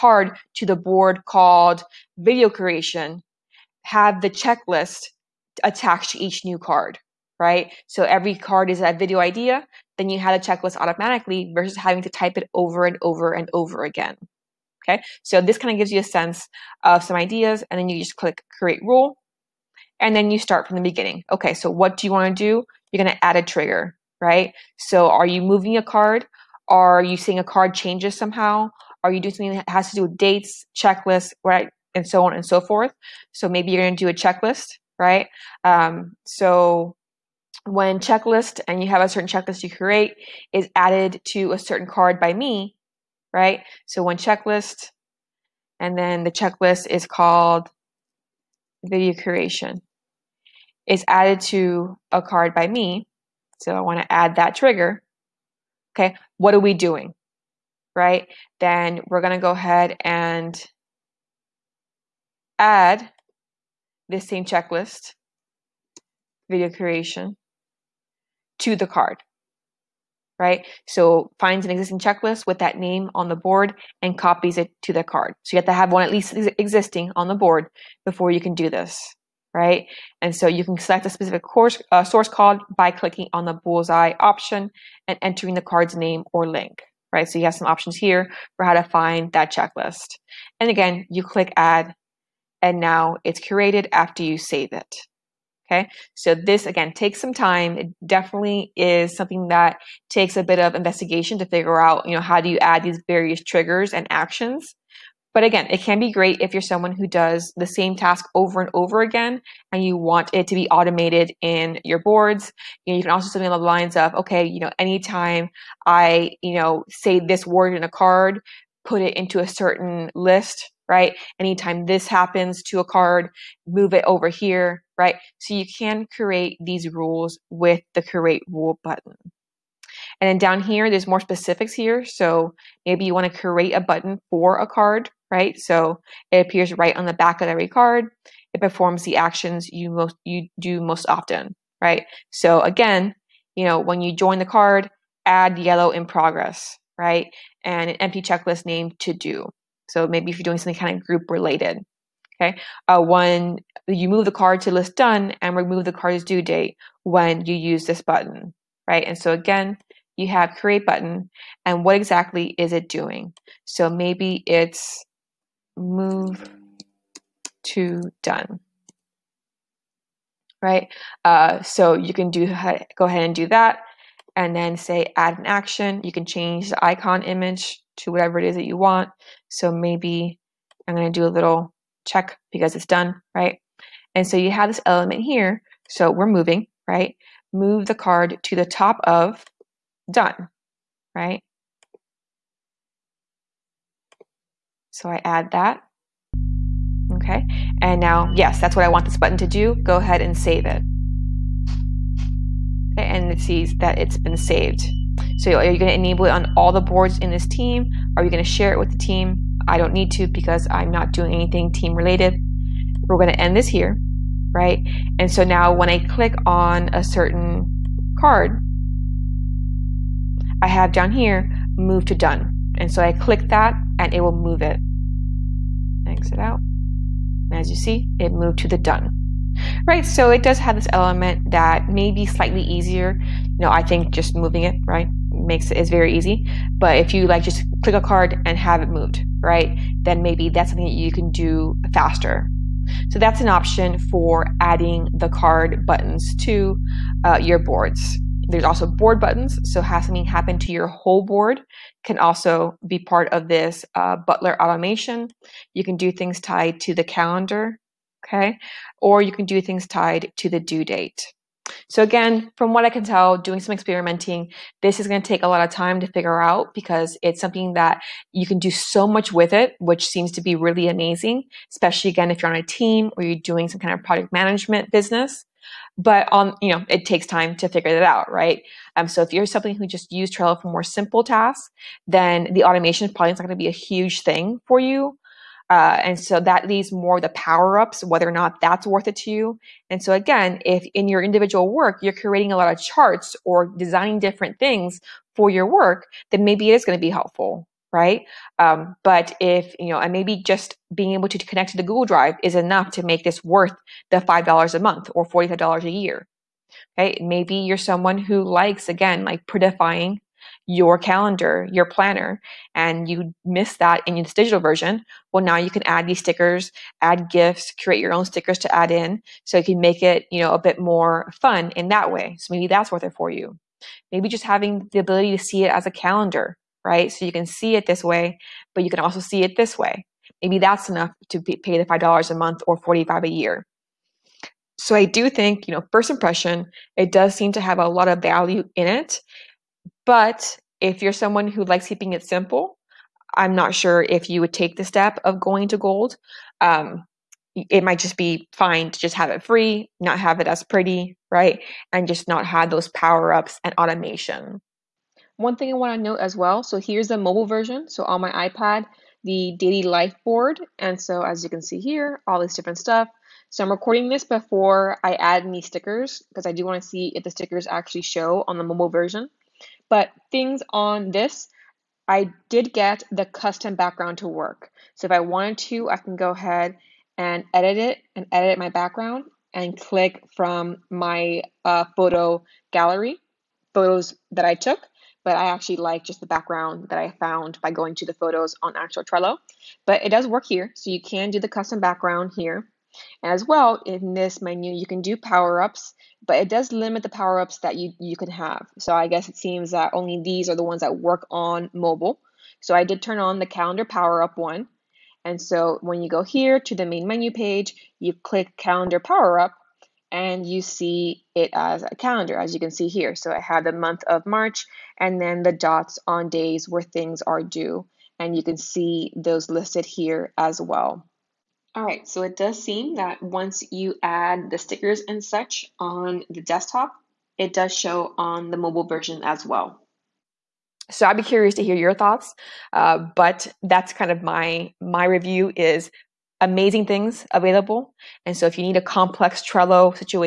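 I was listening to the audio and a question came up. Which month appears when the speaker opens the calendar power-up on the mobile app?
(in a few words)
March.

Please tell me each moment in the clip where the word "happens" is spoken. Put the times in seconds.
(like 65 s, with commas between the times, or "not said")
122 s, 250 s.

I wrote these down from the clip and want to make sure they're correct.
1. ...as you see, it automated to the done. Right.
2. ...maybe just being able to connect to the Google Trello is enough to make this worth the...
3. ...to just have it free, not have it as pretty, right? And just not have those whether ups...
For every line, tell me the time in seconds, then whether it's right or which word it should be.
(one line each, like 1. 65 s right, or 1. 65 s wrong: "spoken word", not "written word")
1. 227 s wrong: "moved", not "automated"
2. 300 s wrong: "Drive", not "Trello"
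3. 348 s wrong: "power", not "whether".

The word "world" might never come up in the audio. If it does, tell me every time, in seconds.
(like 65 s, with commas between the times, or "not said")
not said.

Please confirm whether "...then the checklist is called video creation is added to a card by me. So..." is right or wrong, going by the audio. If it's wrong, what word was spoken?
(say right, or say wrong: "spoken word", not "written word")
right.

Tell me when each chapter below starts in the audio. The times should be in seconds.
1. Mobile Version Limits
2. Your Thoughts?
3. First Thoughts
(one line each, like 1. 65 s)
1. 354 s
2. 430 s
3. 278 s.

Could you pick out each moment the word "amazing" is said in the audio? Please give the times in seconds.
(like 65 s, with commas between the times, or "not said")
270 s, 436 s.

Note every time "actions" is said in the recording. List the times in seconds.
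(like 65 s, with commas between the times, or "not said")
104 s, 139 s, 175 s.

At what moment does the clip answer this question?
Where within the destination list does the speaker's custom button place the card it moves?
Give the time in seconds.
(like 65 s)
188 s.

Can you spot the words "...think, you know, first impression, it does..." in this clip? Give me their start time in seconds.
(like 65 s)
335 s.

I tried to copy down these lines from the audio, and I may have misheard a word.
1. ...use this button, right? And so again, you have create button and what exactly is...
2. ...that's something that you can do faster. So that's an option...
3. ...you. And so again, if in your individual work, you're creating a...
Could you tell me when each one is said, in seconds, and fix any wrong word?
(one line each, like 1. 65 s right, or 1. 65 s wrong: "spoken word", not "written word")
1. 157 s right
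2. 240 s right
3. 289 s right.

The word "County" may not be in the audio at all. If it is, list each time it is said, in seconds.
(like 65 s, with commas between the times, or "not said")
not said.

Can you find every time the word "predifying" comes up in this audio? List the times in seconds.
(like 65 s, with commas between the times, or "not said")
309 s.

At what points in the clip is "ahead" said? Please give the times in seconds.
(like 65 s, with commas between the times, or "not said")
59 s, 173 s, 199 s, 376 s.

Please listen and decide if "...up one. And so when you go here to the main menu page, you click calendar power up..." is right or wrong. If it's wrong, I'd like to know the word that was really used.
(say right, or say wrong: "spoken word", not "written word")
right.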